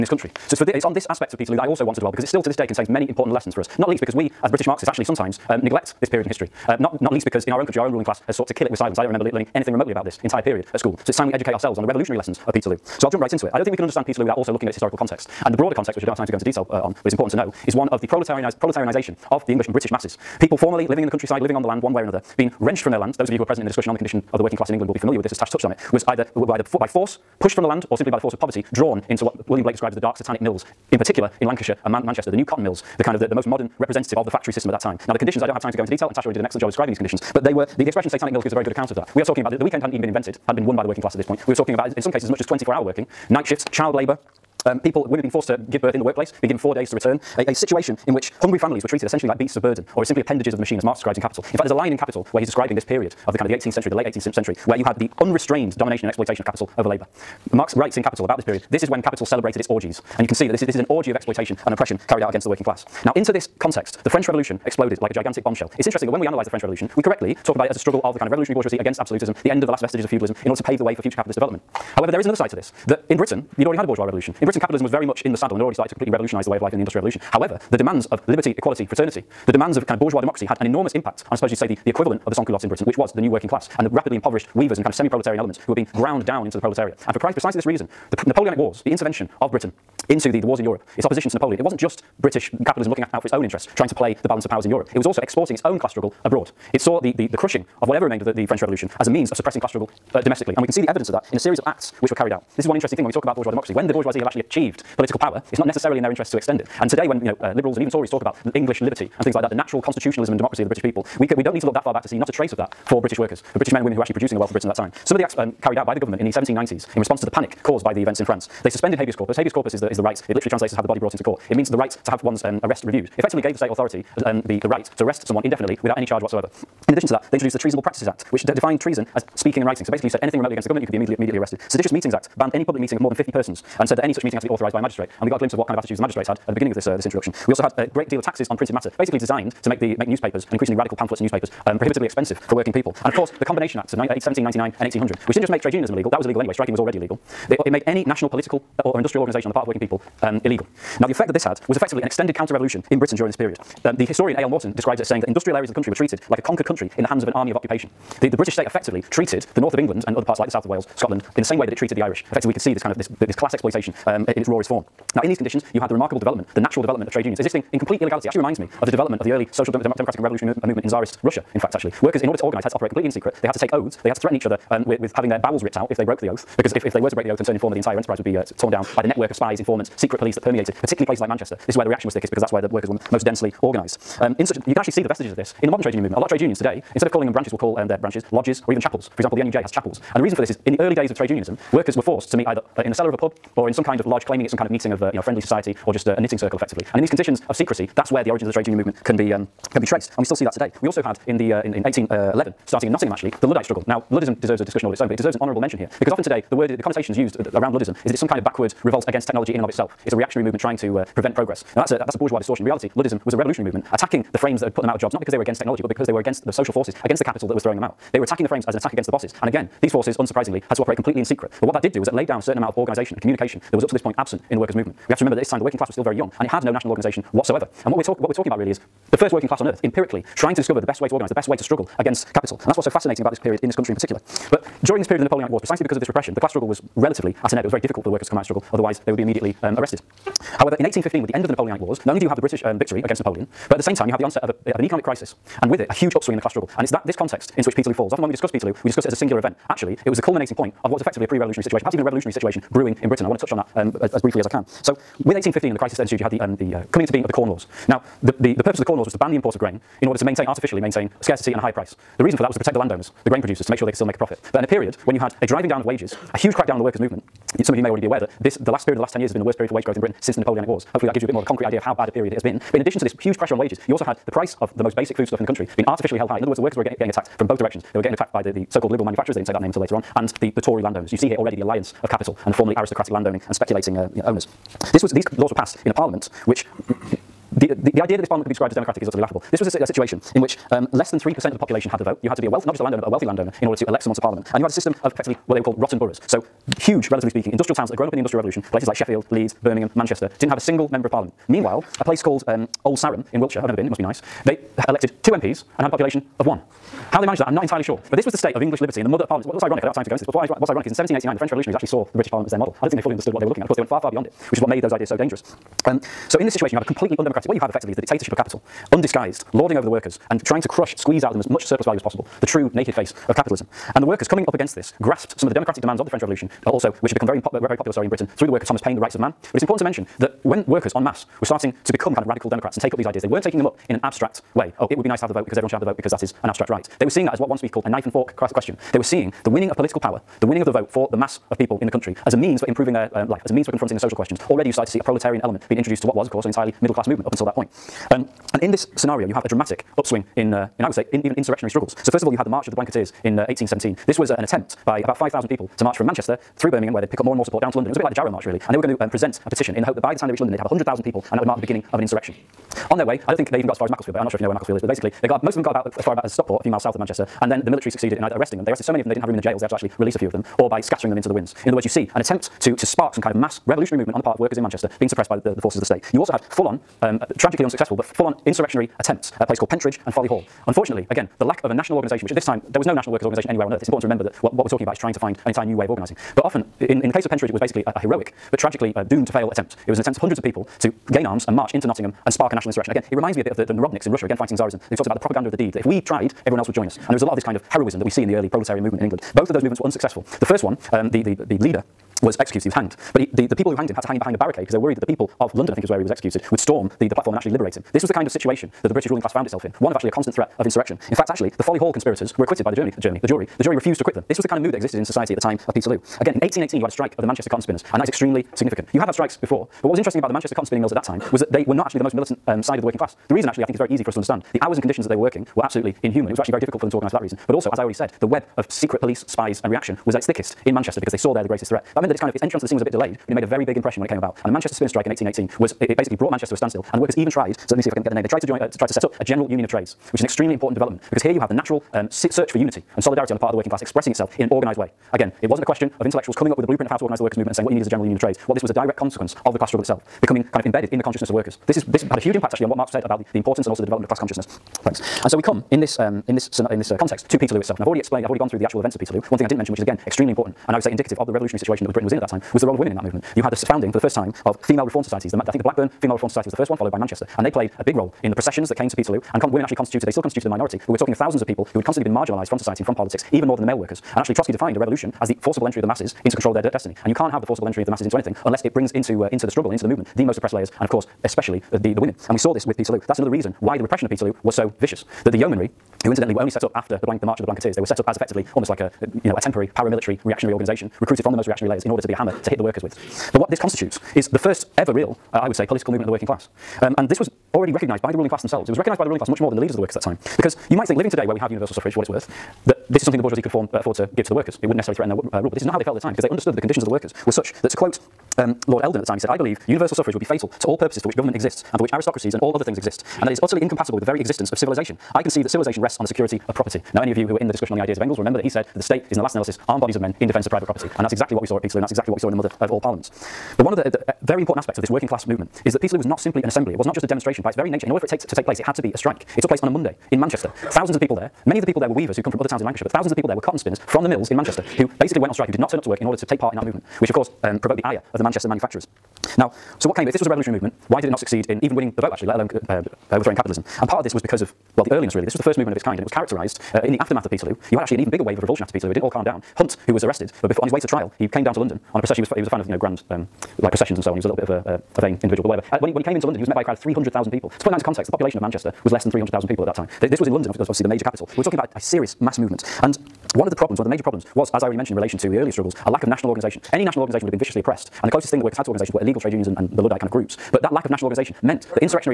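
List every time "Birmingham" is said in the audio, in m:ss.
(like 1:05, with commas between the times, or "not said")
4:59, 5:56.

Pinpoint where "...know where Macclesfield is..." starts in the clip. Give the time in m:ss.
6:04.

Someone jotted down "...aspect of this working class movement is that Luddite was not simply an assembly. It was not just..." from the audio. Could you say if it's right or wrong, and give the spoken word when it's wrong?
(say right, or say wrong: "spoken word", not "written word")
wrong: "Peterloo", not "Luddite".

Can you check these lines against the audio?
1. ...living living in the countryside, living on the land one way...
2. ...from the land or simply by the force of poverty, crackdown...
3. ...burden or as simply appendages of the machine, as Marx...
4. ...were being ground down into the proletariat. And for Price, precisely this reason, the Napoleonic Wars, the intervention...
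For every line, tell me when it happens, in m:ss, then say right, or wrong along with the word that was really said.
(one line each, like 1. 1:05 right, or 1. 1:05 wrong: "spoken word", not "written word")
1. 0:20 right
2. 0:27 wrong: "drawn", not "crackdown"
3. 0:49 right
4. 1:25 right.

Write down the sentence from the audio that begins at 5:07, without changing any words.
How they managed that, I'm not entirely sure.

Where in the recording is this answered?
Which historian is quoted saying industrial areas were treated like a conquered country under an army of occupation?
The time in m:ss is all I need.
2:34.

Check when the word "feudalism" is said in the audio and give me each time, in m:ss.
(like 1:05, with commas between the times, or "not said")
1:10.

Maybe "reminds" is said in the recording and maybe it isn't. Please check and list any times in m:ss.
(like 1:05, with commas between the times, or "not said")
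2:48, 6:33.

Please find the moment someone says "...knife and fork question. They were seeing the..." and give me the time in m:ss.
5:37.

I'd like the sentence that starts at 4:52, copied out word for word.
You had to be a wealth, not just a landowner, but a wealthy landowner in order to elect someone to parliament.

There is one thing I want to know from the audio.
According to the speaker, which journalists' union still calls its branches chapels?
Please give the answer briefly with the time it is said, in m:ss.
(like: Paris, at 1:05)
NUJ, at 3:09.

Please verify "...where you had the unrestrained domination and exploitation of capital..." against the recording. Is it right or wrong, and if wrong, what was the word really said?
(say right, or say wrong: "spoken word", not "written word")
right.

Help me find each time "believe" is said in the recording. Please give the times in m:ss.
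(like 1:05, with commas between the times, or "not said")
8:29.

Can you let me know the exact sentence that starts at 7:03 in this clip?
The reason actually I think is very easy for us to understand.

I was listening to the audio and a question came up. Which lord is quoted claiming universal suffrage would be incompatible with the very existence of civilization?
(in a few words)
Lord Eldon.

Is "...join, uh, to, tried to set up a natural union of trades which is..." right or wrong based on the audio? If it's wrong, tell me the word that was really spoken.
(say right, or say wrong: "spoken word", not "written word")
wrong: "general", not "natural".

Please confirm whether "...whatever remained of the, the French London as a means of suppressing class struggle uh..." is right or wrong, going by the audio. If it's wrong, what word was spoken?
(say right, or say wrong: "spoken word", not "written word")
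wrong: "Revolution", not "London".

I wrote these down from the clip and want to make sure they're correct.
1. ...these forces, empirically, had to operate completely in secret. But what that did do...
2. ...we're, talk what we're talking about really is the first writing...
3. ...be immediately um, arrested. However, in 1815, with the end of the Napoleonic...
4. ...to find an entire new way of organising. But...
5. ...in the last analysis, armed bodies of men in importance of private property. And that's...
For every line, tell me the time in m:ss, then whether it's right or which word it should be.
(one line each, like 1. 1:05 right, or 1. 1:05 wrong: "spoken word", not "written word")
1. 3:39 wrong: "unsurprisingly", not "empirically"
2. 3:47 wrong: "working", not "writing"
3. 3:59 right
4. 6:25 right
5. 8:39 wrong: "defence", not "importance".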